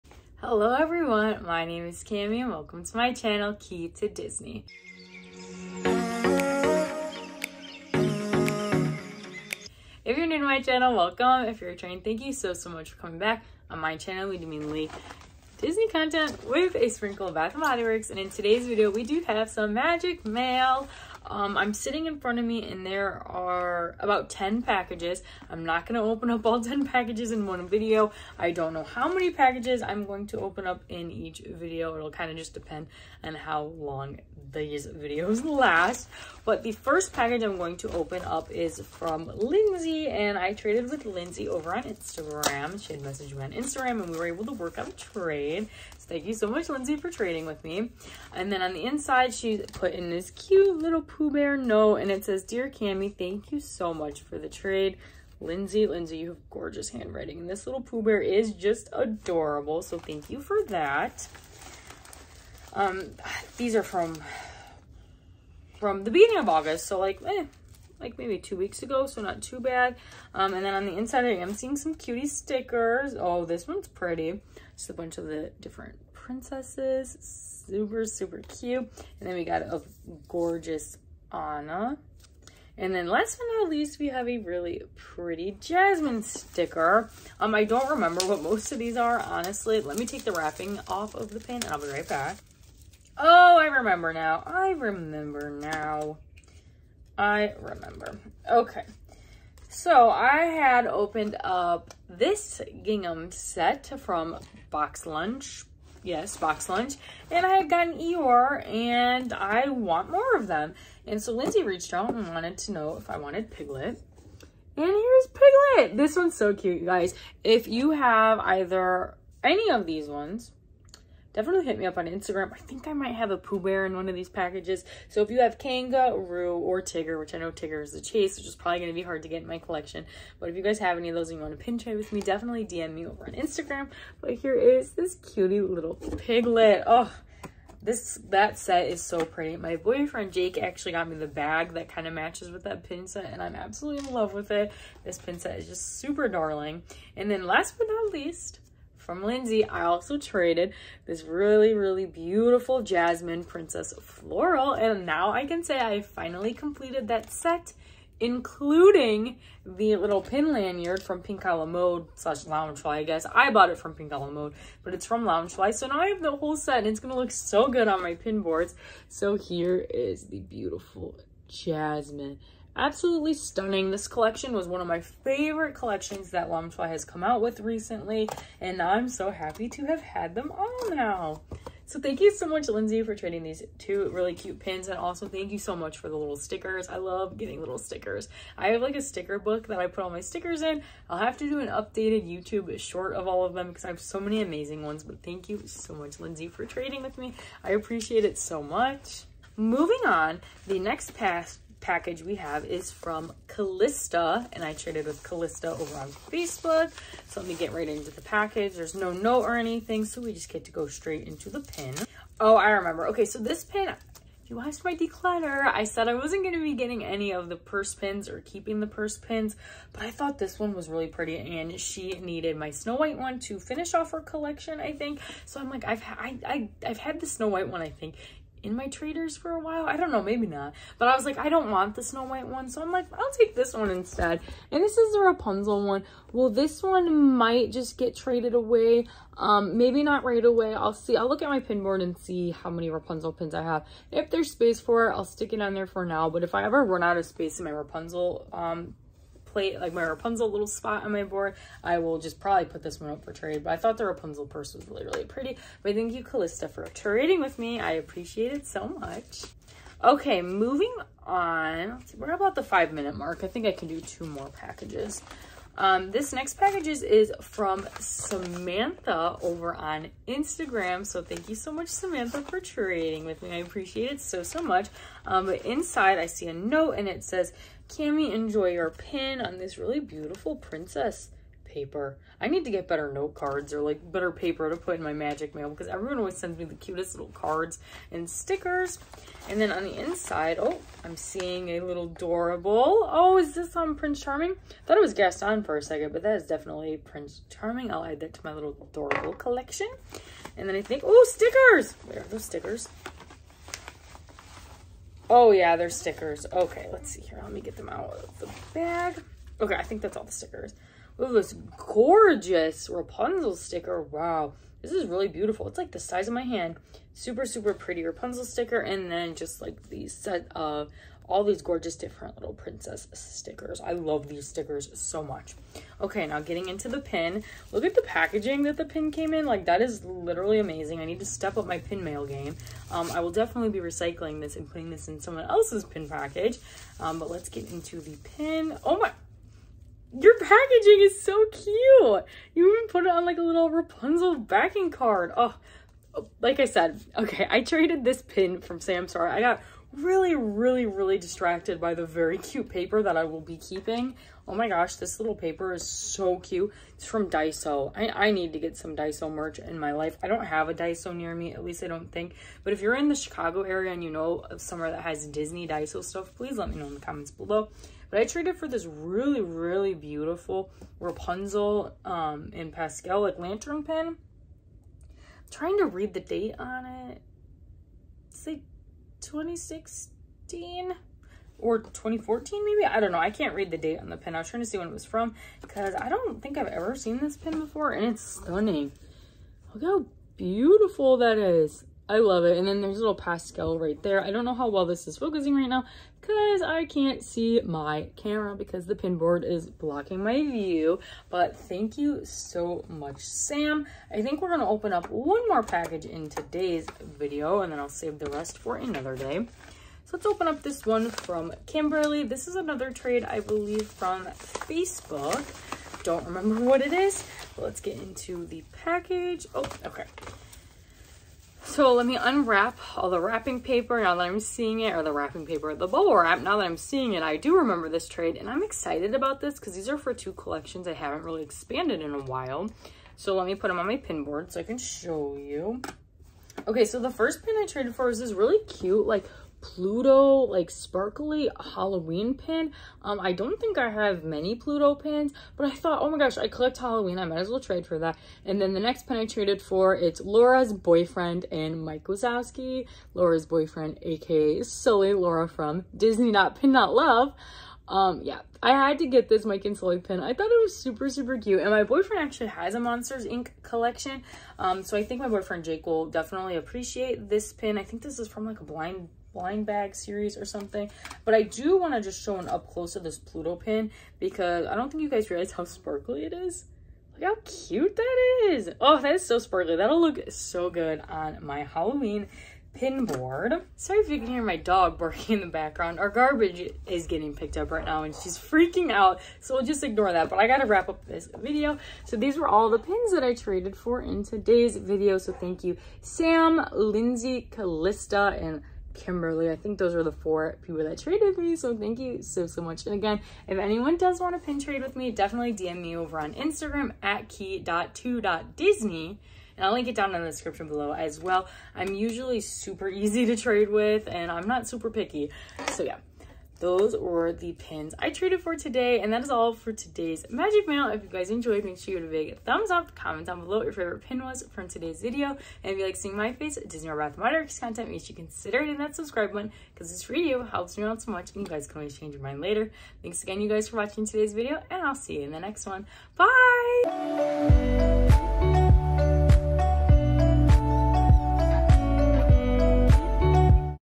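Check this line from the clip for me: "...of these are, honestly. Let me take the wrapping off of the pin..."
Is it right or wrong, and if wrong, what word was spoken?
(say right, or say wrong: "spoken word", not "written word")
right.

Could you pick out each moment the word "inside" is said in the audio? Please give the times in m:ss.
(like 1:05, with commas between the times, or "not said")
0:48, 1:10, 4:35, 4:49.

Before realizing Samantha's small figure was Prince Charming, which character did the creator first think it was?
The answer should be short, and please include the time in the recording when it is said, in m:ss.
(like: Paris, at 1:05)
Gaston, at 4:55.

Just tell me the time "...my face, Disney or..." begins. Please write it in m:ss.
8:46.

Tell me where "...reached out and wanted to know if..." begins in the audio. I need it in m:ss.
1:51.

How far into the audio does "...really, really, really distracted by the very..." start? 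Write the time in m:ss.
5:49.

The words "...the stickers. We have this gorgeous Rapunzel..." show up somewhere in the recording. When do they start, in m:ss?
5:10.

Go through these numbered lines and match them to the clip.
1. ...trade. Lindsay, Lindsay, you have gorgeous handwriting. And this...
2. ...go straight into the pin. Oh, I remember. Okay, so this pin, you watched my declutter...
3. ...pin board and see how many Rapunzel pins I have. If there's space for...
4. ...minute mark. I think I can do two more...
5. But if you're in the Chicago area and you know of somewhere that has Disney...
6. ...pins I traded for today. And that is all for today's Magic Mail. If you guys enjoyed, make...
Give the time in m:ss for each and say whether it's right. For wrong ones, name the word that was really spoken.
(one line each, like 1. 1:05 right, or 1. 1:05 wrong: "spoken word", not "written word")
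1. 0:54 right
2. 3:30 right
3. 4:01 right
4. 4:22 right
5. 6:02 right
6. 8:37 right.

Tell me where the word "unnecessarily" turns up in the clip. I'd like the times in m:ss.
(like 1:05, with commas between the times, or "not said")
not said.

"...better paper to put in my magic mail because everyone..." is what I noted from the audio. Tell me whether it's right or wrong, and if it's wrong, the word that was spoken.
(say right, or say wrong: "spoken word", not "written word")
right.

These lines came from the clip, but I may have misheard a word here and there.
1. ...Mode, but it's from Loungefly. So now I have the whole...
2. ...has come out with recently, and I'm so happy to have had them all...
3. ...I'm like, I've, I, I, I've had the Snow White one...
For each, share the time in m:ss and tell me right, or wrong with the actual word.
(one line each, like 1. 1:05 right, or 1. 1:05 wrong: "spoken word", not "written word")
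1. 2:44 right
2. 2:56 right
3. 3:45 right.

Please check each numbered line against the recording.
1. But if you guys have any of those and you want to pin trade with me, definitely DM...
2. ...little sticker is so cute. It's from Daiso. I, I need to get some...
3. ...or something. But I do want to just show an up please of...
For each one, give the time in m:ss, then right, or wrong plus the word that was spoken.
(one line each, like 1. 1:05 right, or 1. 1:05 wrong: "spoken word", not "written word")
1. 2:10 right
2. 5:55 wrong: "paper", not "sticker"
3. 7:50 wrong: "close", not "please".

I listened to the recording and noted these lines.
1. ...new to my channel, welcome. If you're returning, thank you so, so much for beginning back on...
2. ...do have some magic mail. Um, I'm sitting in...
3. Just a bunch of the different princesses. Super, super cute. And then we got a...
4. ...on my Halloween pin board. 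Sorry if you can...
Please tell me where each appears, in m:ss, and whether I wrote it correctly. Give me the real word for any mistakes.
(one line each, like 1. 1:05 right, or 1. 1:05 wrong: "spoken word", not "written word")
1. 0:10 wrong: "coming", not "beginning"
2. 0:19 right
3. 1:14 right
4. 8:01 right.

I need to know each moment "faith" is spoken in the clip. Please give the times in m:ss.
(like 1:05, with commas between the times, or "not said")
not said.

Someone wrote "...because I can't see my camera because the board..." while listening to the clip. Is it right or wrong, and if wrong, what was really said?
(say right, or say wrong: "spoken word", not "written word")
wrong: "pinboard", not "board".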